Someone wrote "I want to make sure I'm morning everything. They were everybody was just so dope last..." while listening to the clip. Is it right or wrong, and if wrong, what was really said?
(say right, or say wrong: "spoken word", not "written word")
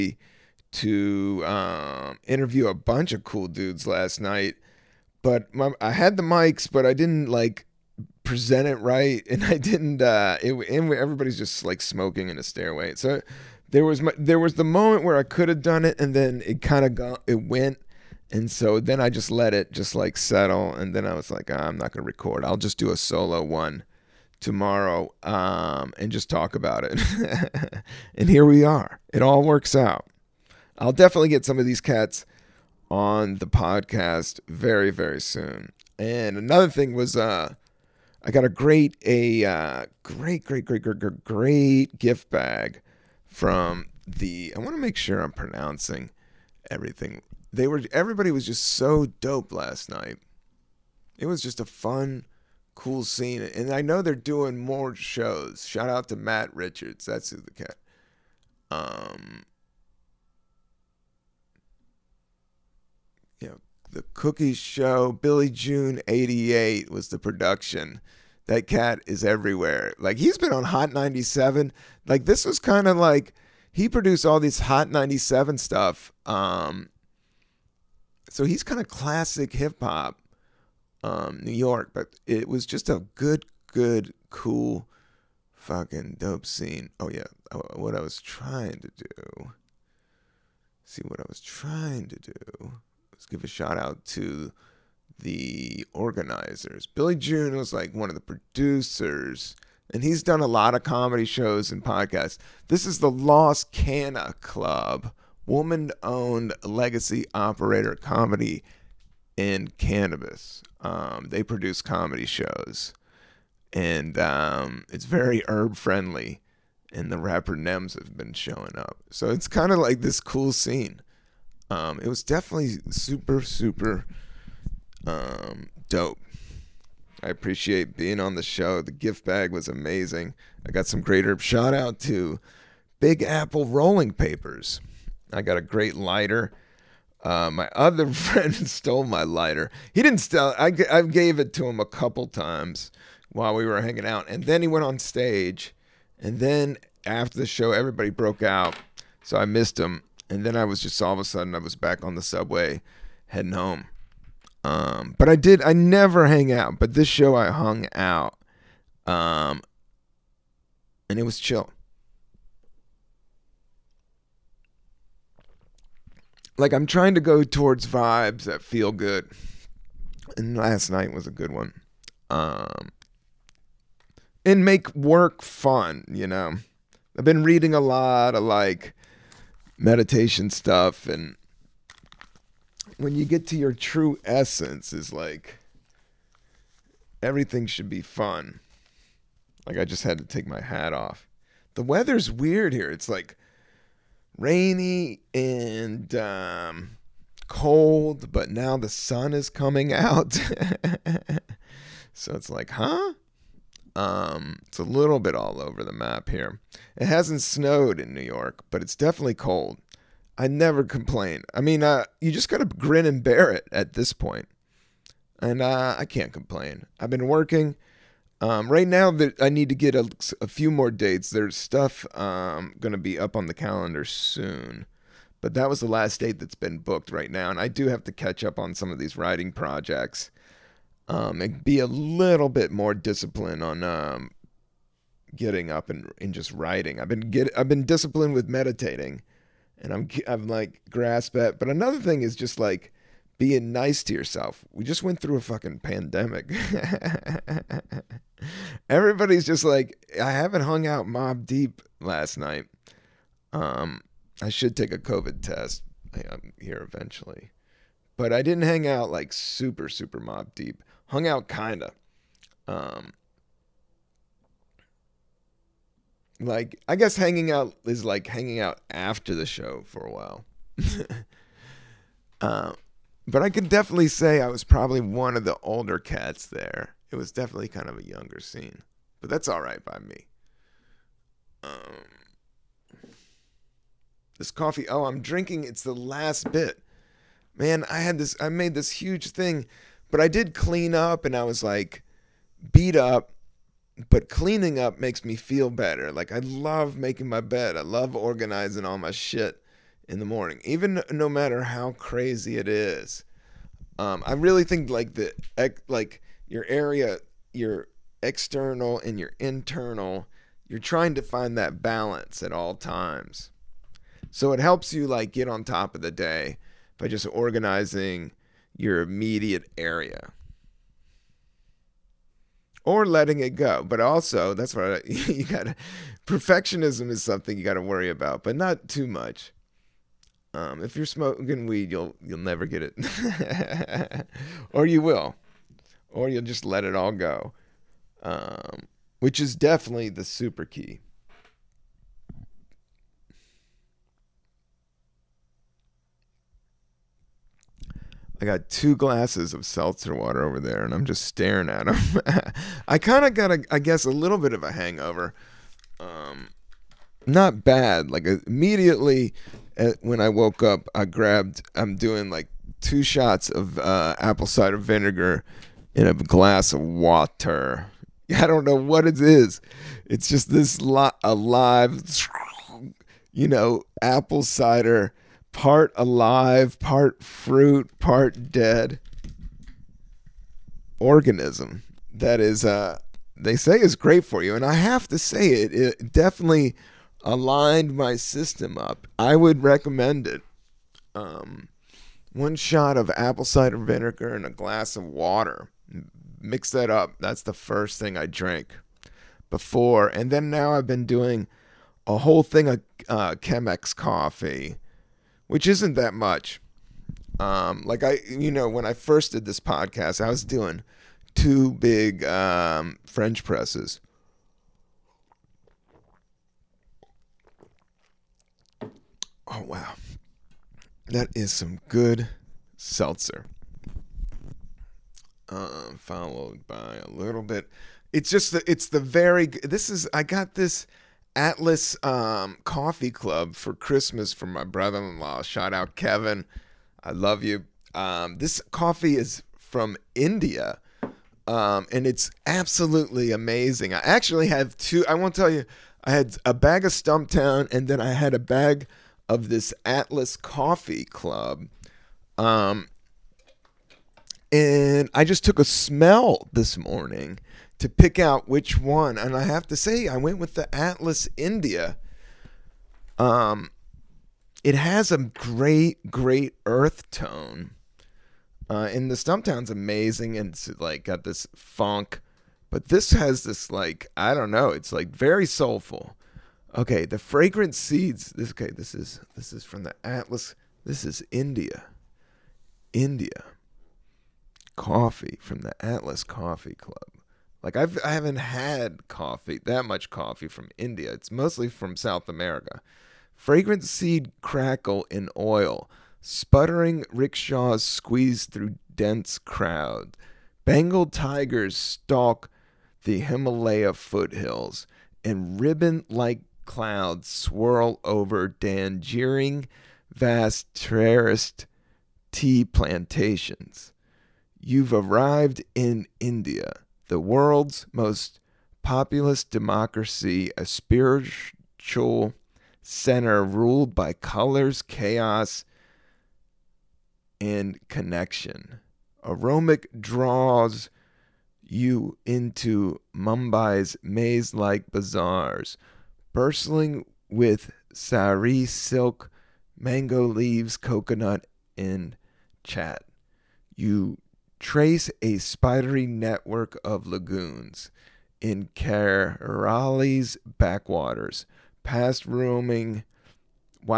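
wrong: "pronouncing", not "morning".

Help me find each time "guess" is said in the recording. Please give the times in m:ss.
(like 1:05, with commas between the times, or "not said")
4:26, 5:53.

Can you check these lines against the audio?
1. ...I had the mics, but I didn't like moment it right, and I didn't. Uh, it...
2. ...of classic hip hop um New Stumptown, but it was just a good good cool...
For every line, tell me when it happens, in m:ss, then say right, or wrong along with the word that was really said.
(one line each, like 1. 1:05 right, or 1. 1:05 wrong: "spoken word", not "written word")
1. 0:05 wrong: "present", not "moment"
2. 1:18 wrong: "York", not "Stumptown".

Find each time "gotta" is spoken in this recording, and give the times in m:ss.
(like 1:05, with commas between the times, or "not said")
not said.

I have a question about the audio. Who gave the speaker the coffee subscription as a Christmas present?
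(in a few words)
Kevin.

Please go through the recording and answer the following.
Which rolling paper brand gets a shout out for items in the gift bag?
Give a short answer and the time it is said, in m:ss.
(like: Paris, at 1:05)
Big Apple Rolling Papers, at 2:12.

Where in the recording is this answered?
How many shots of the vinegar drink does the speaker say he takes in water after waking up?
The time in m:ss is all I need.
6:02.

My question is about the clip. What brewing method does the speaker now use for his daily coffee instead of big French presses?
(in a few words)
Chemex.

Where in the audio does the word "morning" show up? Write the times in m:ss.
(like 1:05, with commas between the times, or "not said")
5:00, 7:36.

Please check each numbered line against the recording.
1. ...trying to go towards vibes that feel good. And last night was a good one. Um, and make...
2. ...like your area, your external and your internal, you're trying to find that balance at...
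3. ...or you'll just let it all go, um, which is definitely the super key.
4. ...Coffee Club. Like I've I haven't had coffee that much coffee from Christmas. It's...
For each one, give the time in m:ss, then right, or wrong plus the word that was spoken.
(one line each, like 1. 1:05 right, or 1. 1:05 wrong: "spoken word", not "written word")
1. 2:46 right
2. 5:05 right
3. 5:36 right
4. 8:06 wrong: "India", not "Christmas".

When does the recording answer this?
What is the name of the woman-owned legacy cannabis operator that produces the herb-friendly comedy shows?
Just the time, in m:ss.
1:43.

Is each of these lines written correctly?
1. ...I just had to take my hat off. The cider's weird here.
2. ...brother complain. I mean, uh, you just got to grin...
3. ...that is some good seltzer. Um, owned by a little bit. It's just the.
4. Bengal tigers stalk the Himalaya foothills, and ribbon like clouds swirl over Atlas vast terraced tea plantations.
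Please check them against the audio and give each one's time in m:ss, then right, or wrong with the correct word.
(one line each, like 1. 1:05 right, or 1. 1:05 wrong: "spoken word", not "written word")
1. 3:09 wrong: "weather", not "cider"
2. 3:30 wrong: "never", not "brother"
3. 7:01 wrong: "followed", not "owned"
4. 8:20 wrong: "Darjeeling", not "Atlas".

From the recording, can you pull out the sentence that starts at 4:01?
But another thing is just like being nice to yourself.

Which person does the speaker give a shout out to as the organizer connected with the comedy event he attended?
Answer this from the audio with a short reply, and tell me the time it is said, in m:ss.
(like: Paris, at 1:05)
Matt Richards, at 0:56.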